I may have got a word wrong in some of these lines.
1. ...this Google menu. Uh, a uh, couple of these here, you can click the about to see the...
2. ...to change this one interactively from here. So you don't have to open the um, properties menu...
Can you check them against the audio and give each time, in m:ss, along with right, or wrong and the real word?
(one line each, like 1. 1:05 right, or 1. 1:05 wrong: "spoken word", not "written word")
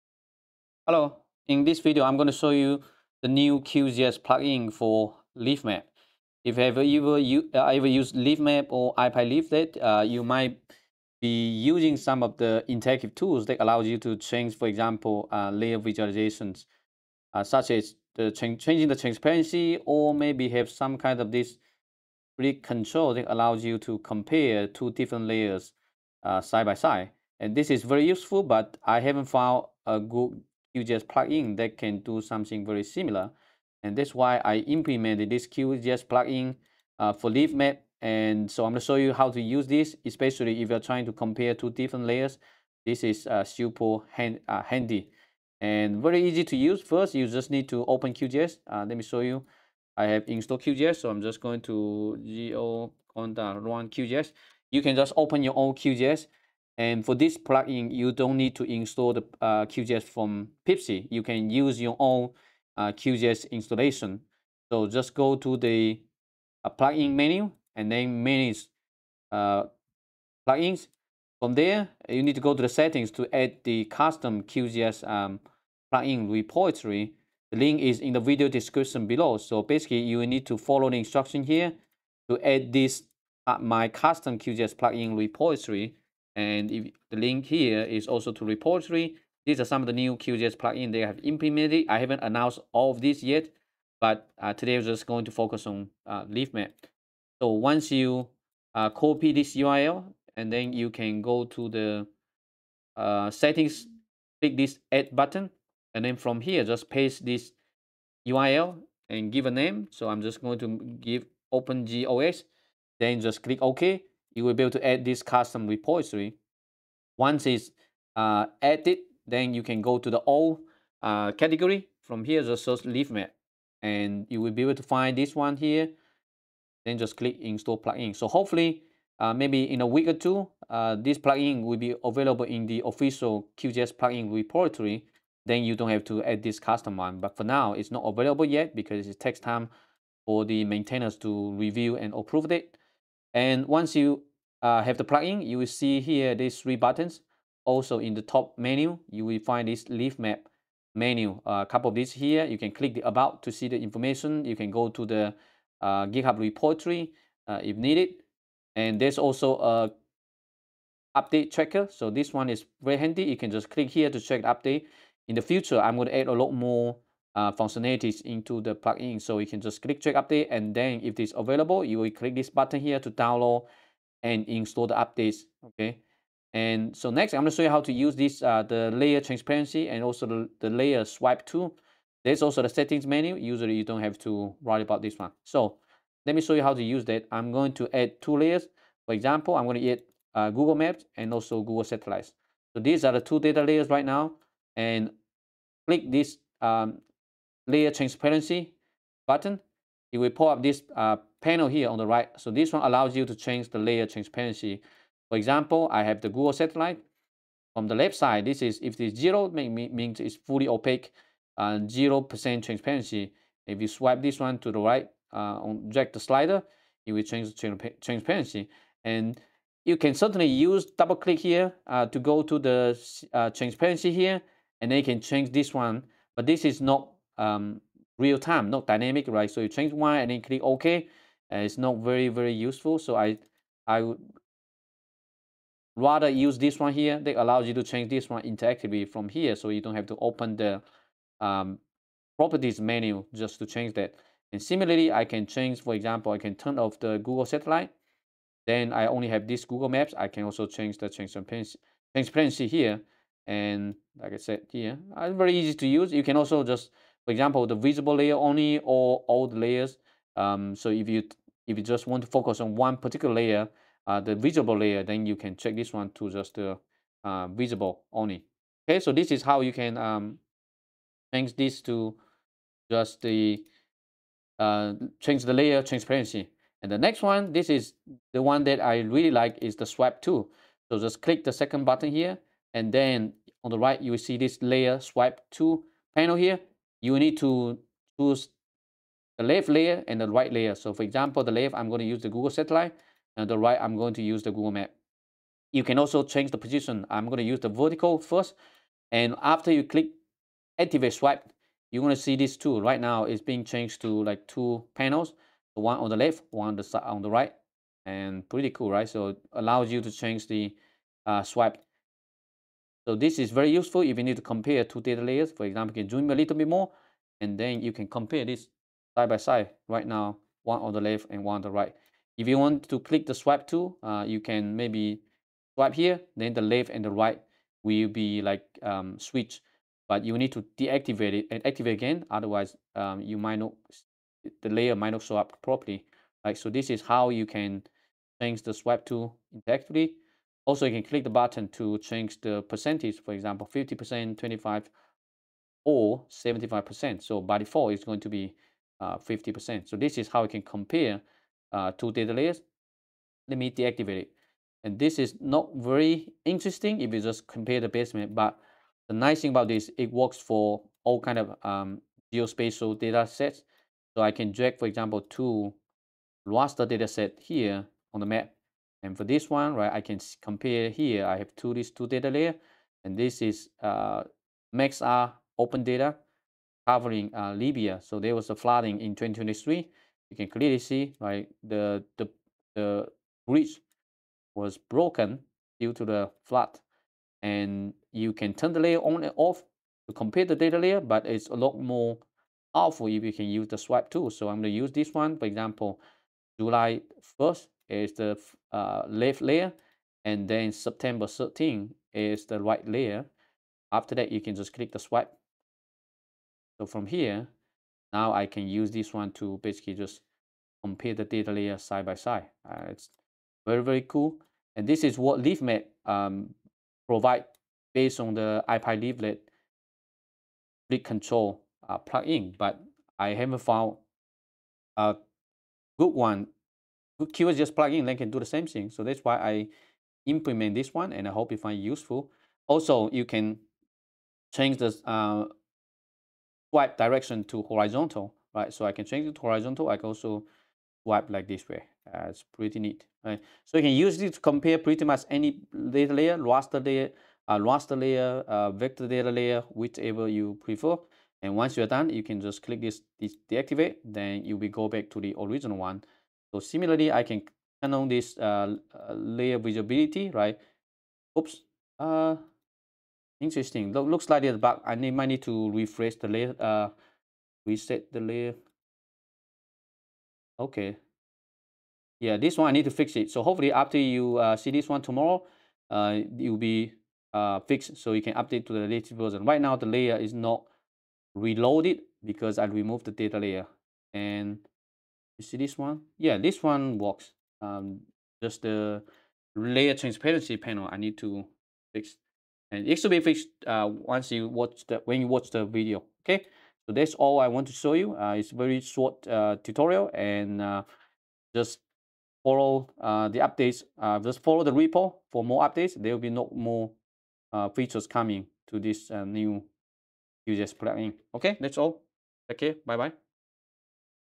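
1. 2:29 wrong: "Leafmap", not "Google"
2. 3:57 right.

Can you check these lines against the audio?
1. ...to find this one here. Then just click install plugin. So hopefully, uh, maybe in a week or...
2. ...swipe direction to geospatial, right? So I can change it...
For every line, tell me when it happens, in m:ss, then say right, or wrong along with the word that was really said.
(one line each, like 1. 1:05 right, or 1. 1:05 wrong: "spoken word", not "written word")
1. 2:04 right
2. 7:16 wrong: "horizontal", not "geospatial".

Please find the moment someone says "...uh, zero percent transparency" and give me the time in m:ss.
3:31.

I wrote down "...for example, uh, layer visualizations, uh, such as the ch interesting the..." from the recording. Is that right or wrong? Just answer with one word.
wrong.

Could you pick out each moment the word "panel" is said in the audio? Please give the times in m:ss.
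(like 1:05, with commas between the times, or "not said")
3:21, 4:46, 5:04, 8:10.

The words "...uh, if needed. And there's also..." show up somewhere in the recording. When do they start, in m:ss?
2:37.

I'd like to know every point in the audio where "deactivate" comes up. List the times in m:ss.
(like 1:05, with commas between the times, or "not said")
5:30, 5:53, 7:33.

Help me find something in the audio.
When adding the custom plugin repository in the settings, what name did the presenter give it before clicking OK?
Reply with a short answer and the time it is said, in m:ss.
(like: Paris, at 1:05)
OpenGeos, at 1:51.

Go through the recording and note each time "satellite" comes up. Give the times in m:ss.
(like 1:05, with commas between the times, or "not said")
3:11, 3:26, 4:07, 4:52.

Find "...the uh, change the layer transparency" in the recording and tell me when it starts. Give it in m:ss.
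4:33.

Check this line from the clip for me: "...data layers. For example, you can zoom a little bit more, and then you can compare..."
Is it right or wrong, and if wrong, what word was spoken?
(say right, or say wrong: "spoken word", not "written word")
right.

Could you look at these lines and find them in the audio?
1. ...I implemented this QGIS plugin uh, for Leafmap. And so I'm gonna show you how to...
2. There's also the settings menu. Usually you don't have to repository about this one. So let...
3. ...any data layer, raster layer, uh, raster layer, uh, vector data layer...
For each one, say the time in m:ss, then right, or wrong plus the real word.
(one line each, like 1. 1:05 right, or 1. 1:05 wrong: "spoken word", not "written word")
1. 0:34 right
2. 3:02 wrong: "worry", not "repository"
3. 7:25 right.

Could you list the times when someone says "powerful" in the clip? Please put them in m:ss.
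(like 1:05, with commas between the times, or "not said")
6:32.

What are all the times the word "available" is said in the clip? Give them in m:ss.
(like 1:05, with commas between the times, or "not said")
2:12, 2:18, 2:51.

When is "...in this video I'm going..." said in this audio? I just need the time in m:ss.
0:01.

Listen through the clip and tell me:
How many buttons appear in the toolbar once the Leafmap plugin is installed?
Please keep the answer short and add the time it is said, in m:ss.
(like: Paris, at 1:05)
3, at 2:26.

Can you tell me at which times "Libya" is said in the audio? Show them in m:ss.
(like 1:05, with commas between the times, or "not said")
6:17.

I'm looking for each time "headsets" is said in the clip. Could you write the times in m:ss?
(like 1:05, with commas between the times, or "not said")
not said.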